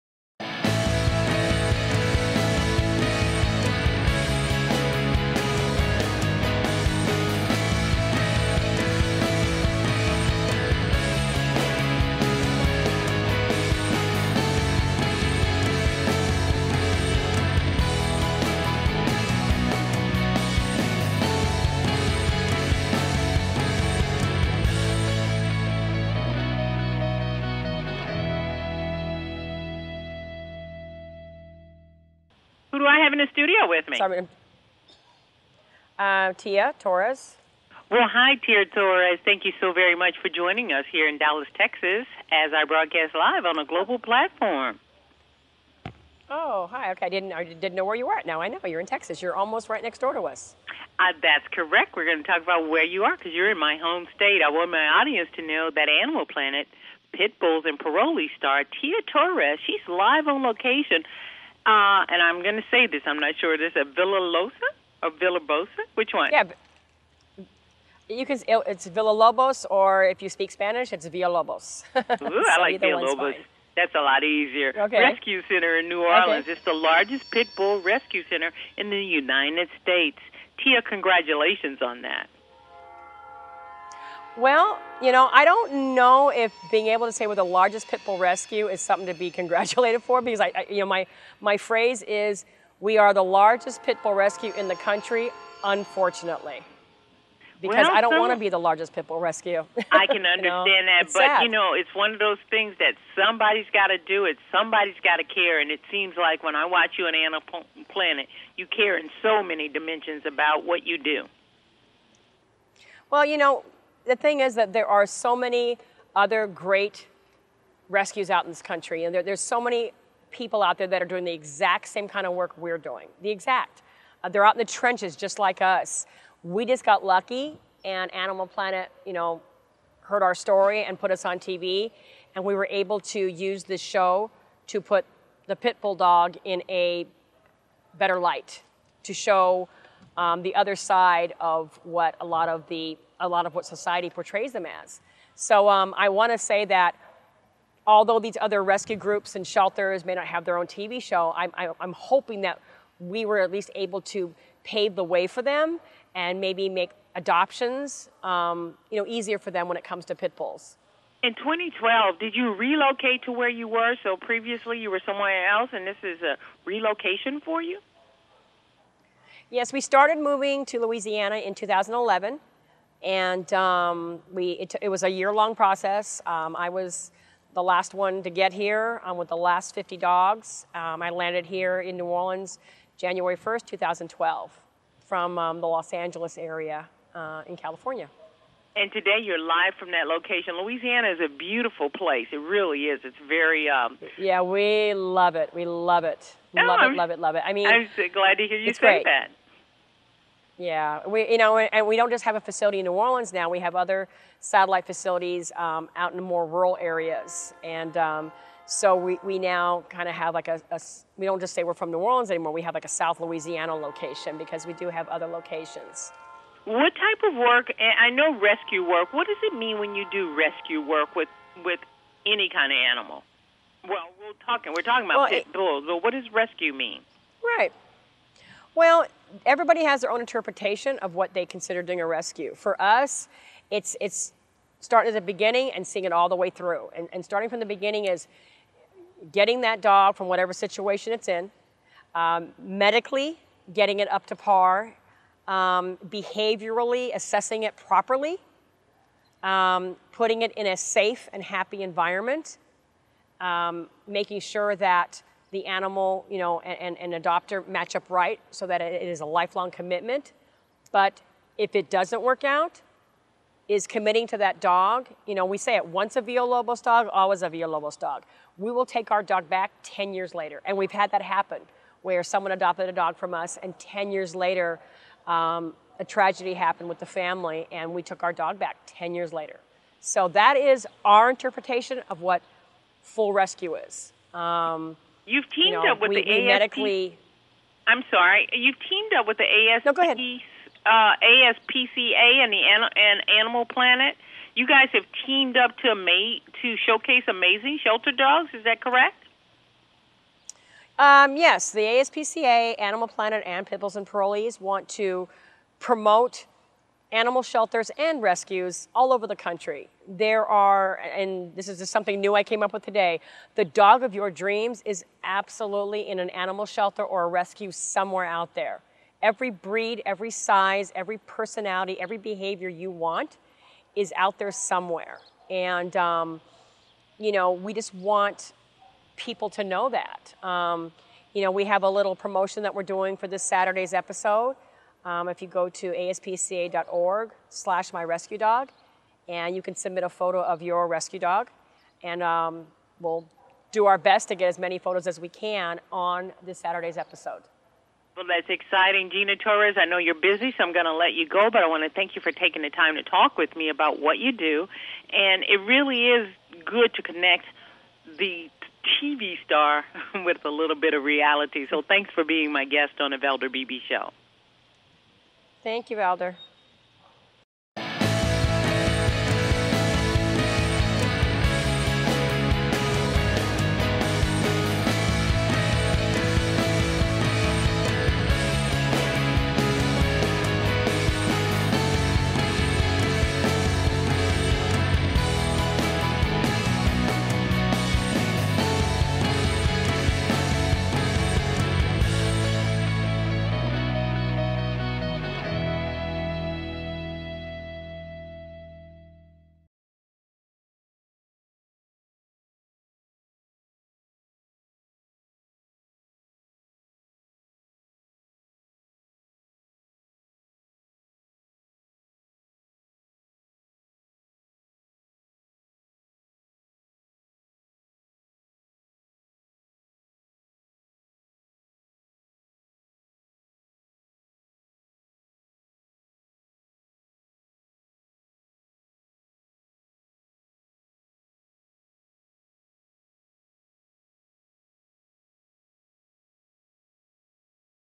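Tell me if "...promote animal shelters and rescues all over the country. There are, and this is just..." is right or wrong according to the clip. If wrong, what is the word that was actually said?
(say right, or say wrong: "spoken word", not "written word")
right.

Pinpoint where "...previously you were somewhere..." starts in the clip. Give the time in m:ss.
2:44.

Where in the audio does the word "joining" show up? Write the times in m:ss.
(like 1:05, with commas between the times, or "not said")
0:40.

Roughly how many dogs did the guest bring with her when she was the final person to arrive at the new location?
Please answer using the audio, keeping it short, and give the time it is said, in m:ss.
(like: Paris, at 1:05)
50, at 2:59.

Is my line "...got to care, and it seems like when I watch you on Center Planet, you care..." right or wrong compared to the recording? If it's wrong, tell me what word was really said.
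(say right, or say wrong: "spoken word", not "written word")
wrong: "Animal", not "Center".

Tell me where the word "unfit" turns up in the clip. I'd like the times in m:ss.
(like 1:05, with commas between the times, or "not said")
not said.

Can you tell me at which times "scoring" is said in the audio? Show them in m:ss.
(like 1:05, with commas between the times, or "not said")
not said.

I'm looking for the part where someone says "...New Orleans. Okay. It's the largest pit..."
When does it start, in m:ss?
1:15.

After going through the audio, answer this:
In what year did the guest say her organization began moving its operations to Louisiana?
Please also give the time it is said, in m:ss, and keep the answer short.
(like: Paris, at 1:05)
2011, at 2:51.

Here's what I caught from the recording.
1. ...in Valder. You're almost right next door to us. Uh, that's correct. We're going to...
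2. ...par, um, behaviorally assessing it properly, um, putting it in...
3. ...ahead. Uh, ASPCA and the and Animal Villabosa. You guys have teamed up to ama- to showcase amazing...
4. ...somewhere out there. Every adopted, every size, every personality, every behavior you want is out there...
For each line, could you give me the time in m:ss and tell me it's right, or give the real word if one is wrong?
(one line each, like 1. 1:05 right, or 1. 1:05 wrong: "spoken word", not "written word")
1. 0:48 wrong: "Texas", not "Valder"
2. 4:04 right
3. 4:50 wrong: "Planet", not "Villabosa"
4. 5:17 wrong: "breed", not "adopted".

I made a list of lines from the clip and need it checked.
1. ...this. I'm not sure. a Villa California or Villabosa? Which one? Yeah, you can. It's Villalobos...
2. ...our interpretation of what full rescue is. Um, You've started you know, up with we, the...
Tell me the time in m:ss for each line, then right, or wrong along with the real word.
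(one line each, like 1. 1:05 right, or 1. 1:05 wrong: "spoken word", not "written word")
1. 1:02 wrong: "Villalosa", not "California"
2. 4:41 wrong: "teamed", not "started".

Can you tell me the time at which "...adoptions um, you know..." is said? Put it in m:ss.
2:37.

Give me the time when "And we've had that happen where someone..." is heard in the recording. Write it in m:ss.
4:30.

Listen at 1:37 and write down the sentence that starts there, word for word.
Because well, I don't so want to be the largest pit bull rescue.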